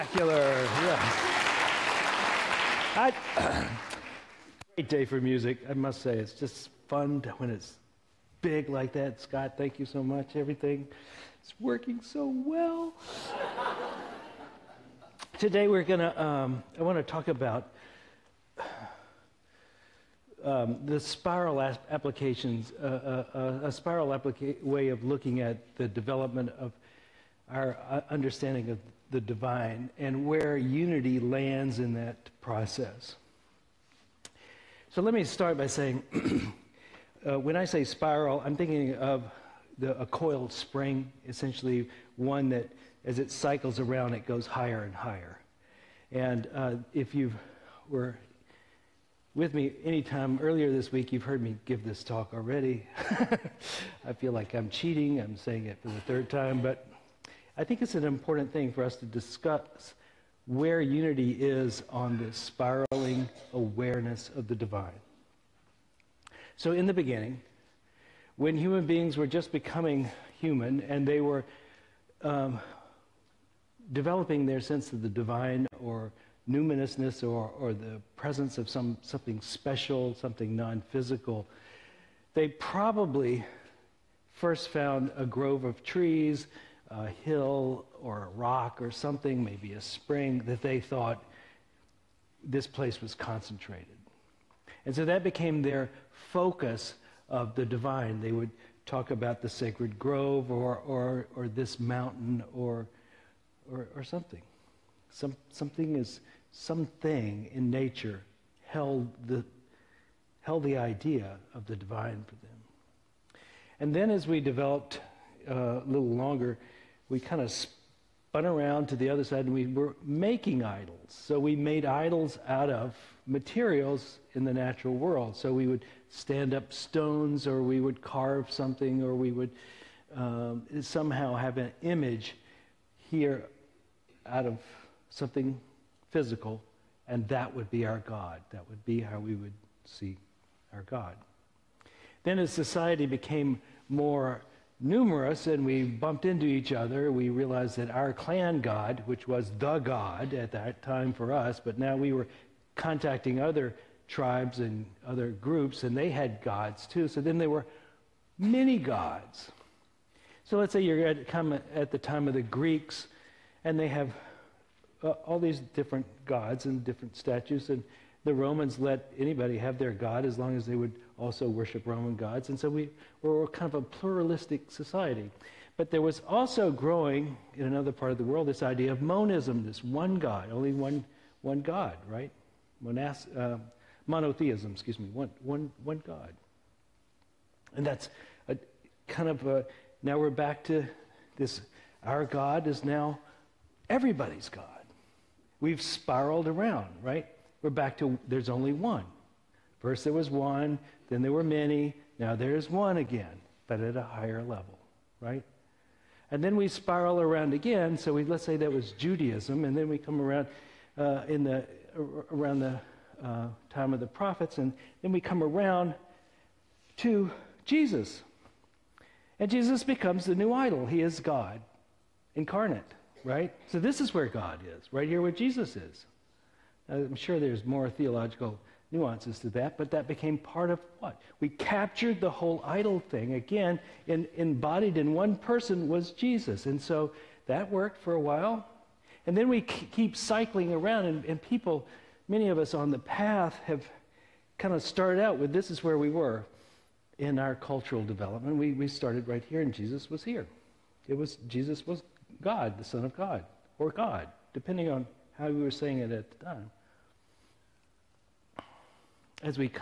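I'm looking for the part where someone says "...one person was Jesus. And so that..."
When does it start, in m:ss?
3:55.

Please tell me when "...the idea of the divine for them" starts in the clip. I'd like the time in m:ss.
1:50.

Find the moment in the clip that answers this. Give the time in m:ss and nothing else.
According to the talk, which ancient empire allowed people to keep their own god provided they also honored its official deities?
2:48.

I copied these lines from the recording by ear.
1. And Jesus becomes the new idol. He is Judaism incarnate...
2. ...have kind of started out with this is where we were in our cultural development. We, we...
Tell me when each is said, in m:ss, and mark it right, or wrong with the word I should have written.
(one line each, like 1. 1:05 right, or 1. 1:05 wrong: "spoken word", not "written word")
1. 3:39 wrong: "God", not "Judaism"
2. 4:03 right.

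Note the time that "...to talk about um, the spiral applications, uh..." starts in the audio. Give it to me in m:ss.
0:16.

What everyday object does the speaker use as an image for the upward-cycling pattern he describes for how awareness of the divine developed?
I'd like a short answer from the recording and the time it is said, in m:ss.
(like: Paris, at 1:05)
A coiled spring, at 0:40.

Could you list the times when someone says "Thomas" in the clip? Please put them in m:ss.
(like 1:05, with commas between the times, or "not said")
not said.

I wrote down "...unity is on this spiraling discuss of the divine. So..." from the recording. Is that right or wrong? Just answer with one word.
wrong.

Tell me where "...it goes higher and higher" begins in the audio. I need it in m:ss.
0:44.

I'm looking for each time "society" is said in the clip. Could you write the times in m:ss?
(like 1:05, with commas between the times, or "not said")
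2:22, 2:54.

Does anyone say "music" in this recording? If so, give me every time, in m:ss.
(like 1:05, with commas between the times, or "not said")
0:05.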